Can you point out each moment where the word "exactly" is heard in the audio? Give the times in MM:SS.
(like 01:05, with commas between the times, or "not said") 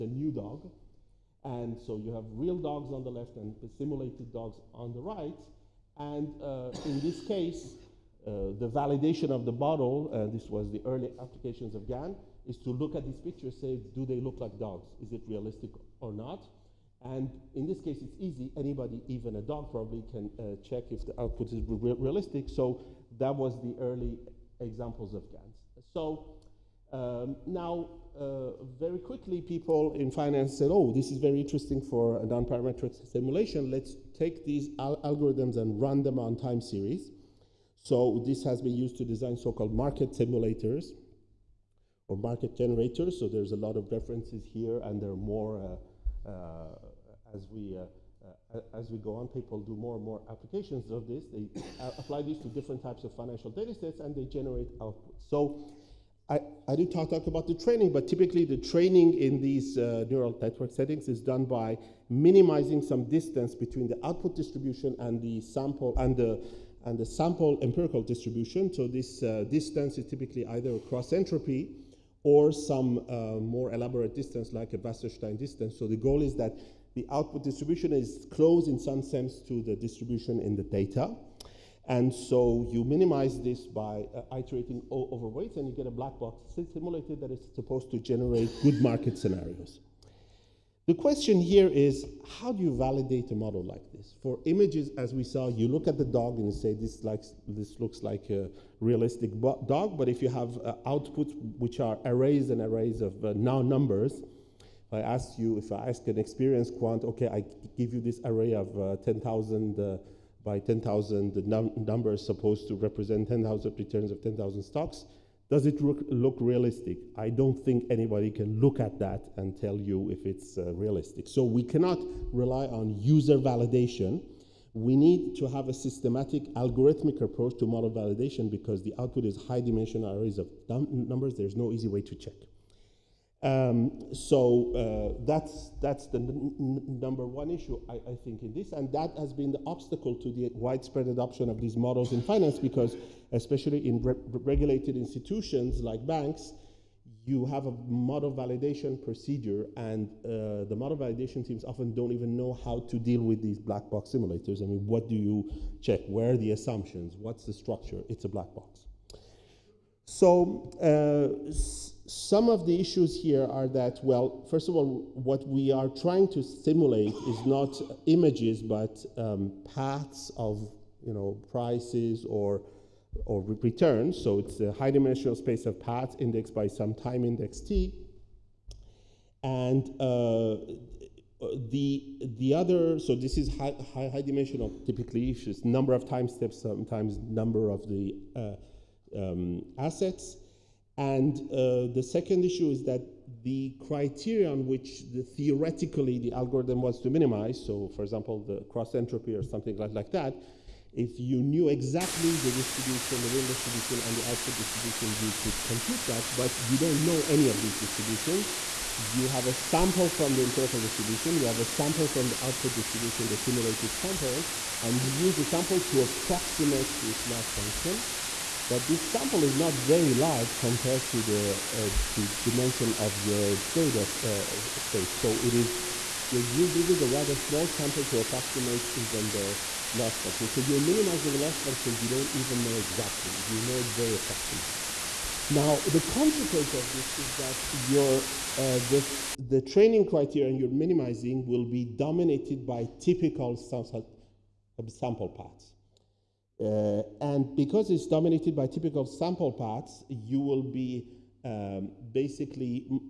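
03:21, 03:52.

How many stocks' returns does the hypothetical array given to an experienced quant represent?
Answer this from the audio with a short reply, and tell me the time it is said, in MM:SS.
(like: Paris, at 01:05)
10,000, at 01:54.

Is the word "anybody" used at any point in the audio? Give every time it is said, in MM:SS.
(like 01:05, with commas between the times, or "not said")
00:18, 01:57.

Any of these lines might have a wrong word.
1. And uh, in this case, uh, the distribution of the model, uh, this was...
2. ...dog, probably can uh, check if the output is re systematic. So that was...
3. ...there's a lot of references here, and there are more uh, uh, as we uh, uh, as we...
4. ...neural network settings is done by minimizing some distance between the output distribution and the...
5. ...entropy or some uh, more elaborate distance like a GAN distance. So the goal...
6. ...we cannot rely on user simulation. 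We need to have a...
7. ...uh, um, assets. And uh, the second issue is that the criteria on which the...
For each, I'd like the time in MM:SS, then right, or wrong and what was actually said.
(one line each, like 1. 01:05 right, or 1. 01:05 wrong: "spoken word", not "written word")
1. 00:05 wrong: "validation", not "distribution"
2. 00:19 wrong: "realistic", not "systematic"
3. 00:43 right
4. 01:00 right
5. 01:11 wrong: "Wasserstein", not "GAN"
6. 02:01 wrong: "validation", not "simulation"
7. 03:08 right.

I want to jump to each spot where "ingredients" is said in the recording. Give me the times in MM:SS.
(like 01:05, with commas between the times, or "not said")
not said.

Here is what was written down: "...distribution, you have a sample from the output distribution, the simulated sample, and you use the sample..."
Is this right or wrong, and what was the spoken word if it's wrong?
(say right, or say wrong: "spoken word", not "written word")
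right.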